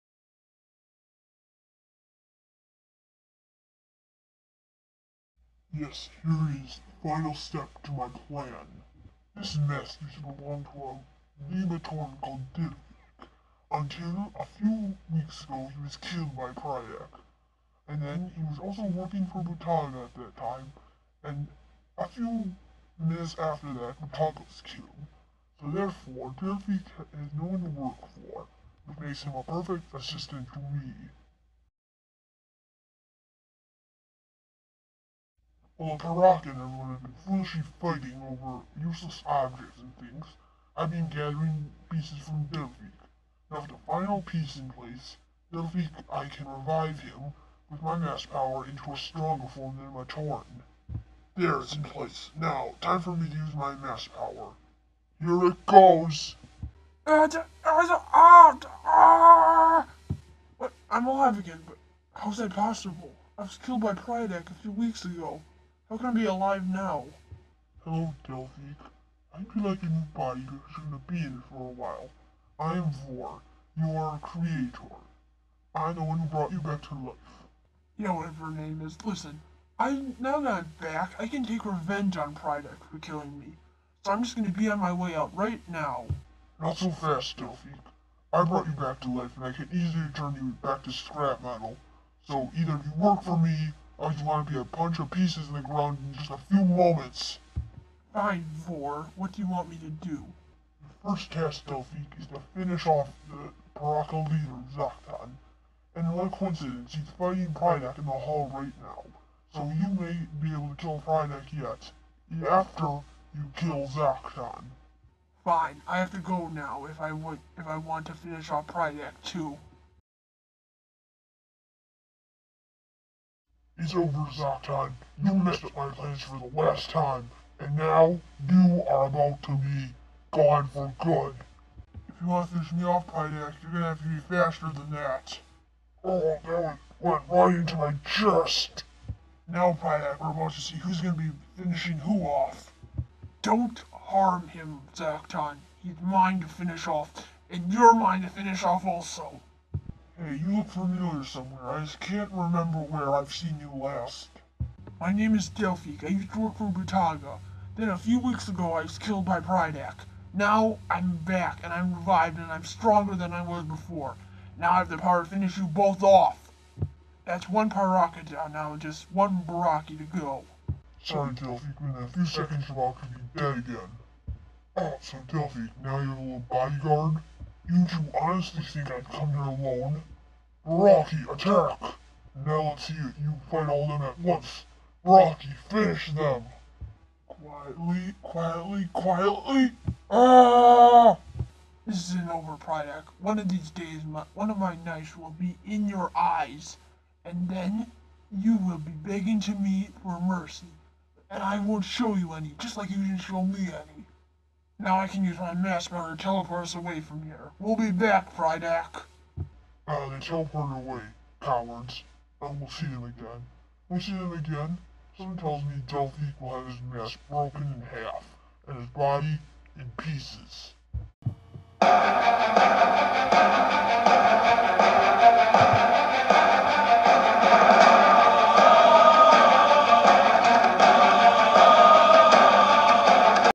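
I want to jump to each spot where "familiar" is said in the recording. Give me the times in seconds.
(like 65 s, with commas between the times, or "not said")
150 s.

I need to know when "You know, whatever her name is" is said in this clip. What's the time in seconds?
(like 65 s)
77 s.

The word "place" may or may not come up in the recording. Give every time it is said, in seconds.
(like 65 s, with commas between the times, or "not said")
44 s, 51 s.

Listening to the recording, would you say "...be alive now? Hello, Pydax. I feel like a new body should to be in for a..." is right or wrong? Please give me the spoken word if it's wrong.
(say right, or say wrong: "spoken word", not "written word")
wrong: "Delphi", not "Pydax".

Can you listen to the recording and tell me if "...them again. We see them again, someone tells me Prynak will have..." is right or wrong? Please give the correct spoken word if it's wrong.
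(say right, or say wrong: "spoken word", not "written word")
wrong: "Delphique", not "Prynak".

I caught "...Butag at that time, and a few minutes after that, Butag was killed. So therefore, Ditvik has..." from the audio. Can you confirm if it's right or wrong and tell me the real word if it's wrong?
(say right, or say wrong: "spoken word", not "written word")
right.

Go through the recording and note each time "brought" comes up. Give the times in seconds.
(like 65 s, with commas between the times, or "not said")
76 s, 88 s.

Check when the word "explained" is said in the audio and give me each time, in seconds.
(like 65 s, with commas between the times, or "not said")
not said.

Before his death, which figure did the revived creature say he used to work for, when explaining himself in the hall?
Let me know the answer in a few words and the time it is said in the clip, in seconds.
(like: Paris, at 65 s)
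Butaga, at 156 s.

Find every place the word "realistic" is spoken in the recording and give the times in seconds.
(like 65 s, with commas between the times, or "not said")
not said.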